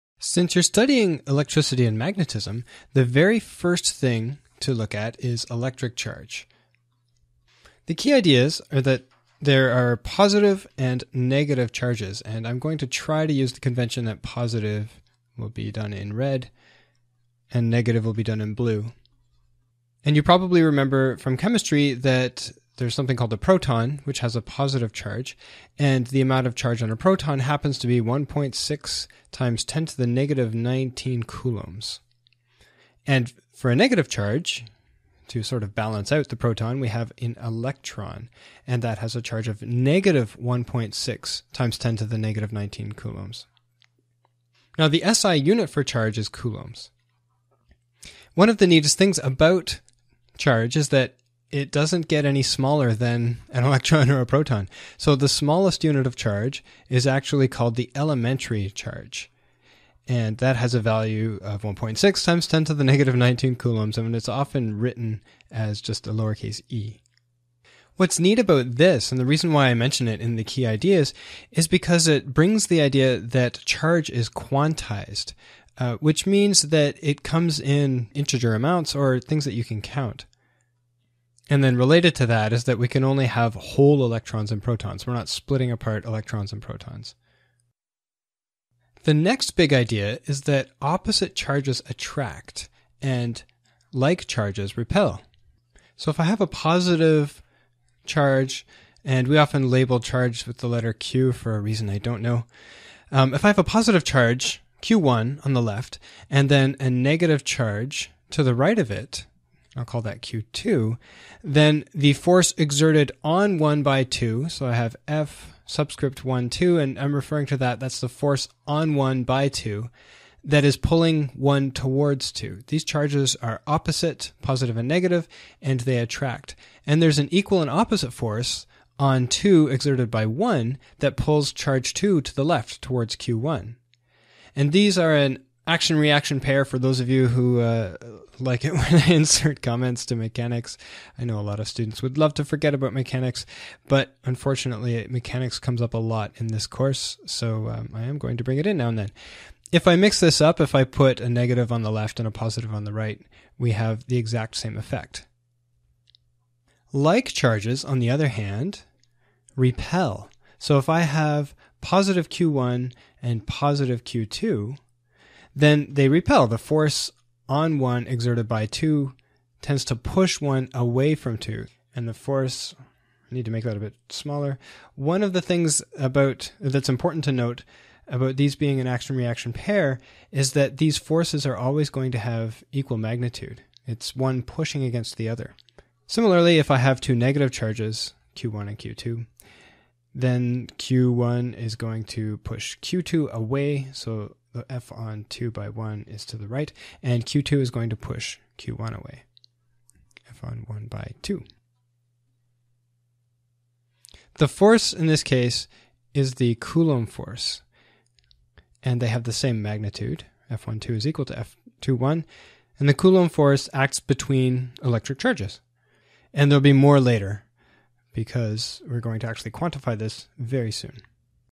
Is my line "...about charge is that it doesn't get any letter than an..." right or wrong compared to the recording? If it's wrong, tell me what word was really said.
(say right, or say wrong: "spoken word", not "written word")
wrong: "smaller", not "letter".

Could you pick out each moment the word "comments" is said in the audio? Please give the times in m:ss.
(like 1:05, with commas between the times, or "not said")
2:19.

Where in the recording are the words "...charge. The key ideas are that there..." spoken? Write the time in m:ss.
0:05.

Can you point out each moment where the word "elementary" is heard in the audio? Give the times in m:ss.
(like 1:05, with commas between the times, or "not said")
0:57.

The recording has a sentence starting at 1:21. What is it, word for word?
And then related to that is that we can only have whole electrons and protons.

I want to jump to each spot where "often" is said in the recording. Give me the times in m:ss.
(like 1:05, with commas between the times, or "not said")
1:04, 1:39.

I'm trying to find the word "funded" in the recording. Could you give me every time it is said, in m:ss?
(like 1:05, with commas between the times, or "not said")
not said.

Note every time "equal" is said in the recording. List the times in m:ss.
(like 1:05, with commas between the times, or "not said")
2:07, 3:02, 3:31.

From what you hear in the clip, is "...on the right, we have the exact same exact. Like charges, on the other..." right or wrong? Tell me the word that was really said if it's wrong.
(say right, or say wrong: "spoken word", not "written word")
wrong: "effect", not "exact".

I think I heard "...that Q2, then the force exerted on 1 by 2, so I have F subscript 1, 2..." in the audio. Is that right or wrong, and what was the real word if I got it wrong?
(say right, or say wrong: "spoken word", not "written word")
right.